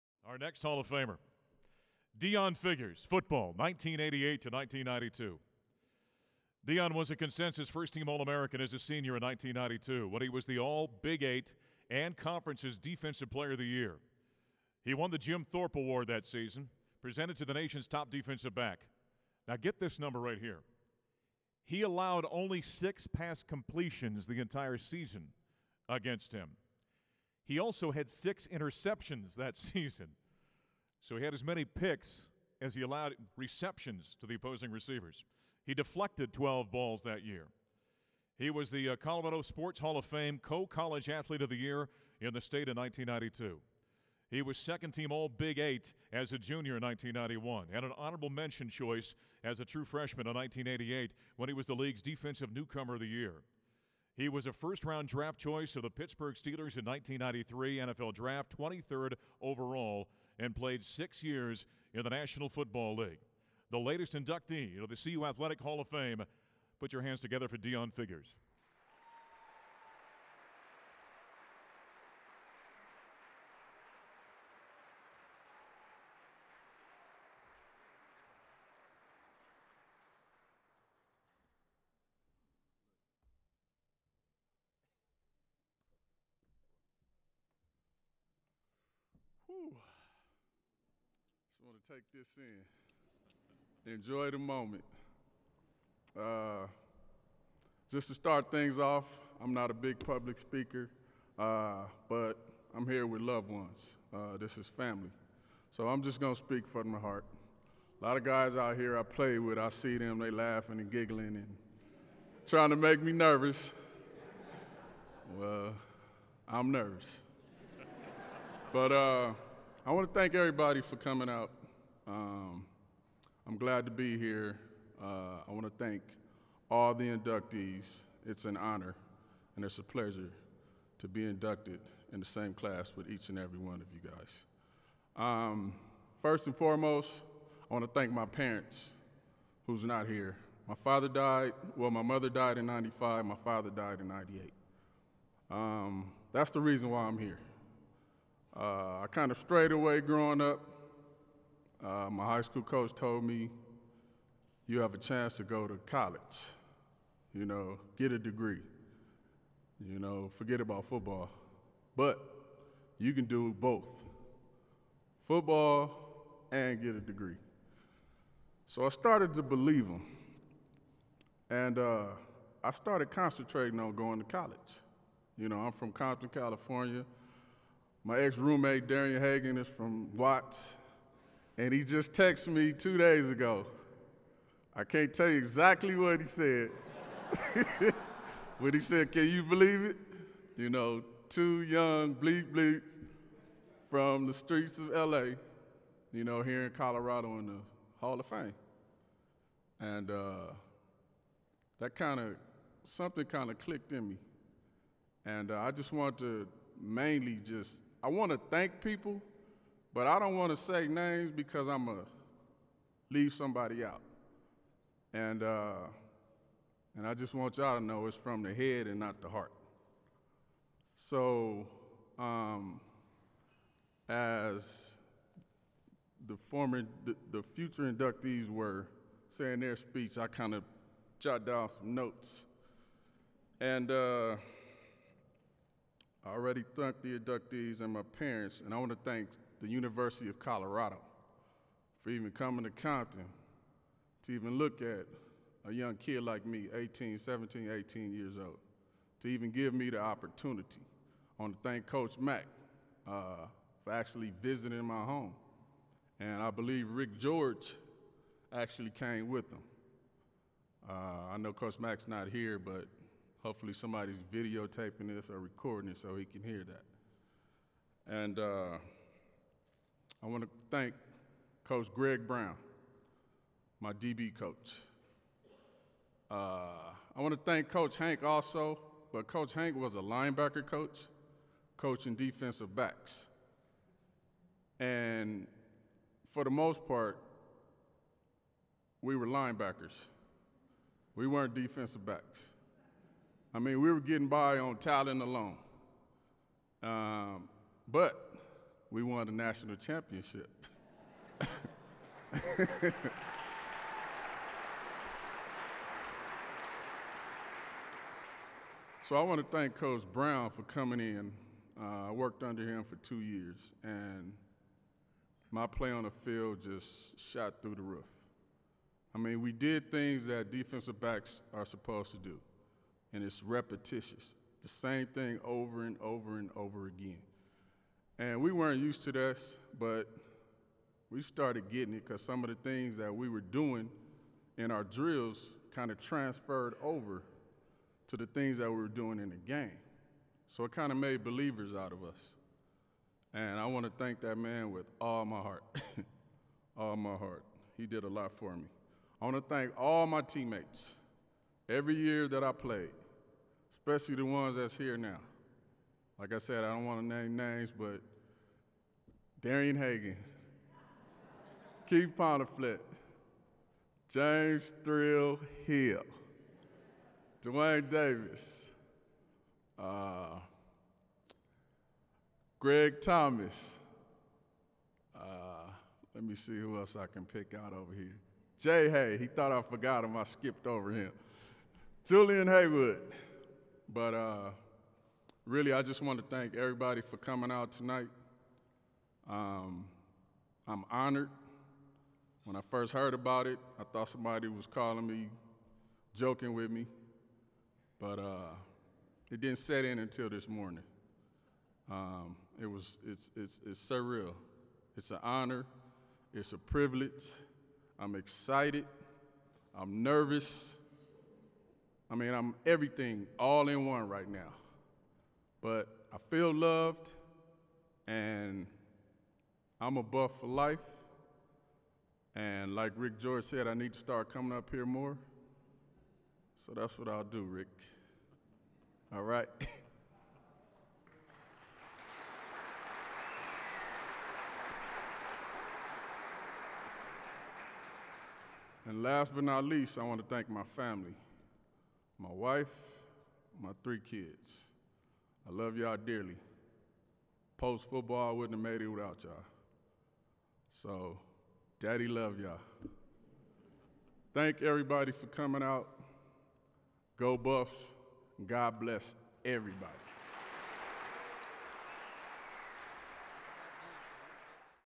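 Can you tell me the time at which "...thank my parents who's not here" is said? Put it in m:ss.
2:17.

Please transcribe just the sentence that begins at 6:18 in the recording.
Jay Hay, he thought I forgot him.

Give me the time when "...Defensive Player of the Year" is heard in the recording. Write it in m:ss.
0:12.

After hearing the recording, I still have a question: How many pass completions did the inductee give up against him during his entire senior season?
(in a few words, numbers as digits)
6.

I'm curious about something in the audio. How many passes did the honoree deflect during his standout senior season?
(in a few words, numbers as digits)
12.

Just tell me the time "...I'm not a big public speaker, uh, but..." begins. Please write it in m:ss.
1:39.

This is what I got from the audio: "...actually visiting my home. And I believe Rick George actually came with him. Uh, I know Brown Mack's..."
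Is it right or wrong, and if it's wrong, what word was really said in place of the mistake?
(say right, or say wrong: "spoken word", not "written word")
wrong: "Coach", not "Brown".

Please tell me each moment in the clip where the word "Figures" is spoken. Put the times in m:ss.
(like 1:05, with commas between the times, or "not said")
0:02, 1:07.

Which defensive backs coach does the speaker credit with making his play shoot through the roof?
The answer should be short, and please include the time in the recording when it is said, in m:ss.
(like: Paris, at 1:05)
Greg Brown, at 4:31.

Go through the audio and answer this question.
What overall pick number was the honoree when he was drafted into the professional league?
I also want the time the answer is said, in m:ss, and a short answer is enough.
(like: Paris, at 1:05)
23rd, at 0:58.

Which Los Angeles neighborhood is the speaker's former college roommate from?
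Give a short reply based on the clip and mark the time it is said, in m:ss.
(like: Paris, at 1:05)
Watts, at 3:00.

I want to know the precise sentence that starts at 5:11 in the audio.
Uh, I worked under him for two years, and my play on the field just shot through the roof.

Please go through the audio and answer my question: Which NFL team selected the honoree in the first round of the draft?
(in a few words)
Pittsburgh Steelers.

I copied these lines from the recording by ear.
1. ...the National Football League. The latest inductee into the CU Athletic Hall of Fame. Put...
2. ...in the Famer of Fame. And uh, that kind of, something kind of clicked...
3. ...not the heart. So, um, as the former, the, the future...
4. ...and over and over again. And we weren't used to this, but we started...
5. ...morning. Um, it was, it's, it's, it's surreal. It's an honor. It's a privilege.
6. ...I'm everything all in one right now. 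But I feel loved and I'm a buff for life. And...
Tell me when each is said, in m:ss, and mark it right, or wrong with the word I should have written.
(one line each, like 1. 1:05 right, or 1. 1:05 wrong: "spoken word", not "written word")
1. 1:02 right
2. 3:17 wrong: "Hall", not "Famer"
3. 3:38 right
4. 5:25 right
5. 6:40 right
6. 6:52 right.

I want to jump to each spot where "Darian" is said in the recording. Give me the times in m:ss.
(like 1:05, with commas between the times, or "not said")
2:58, 5:59.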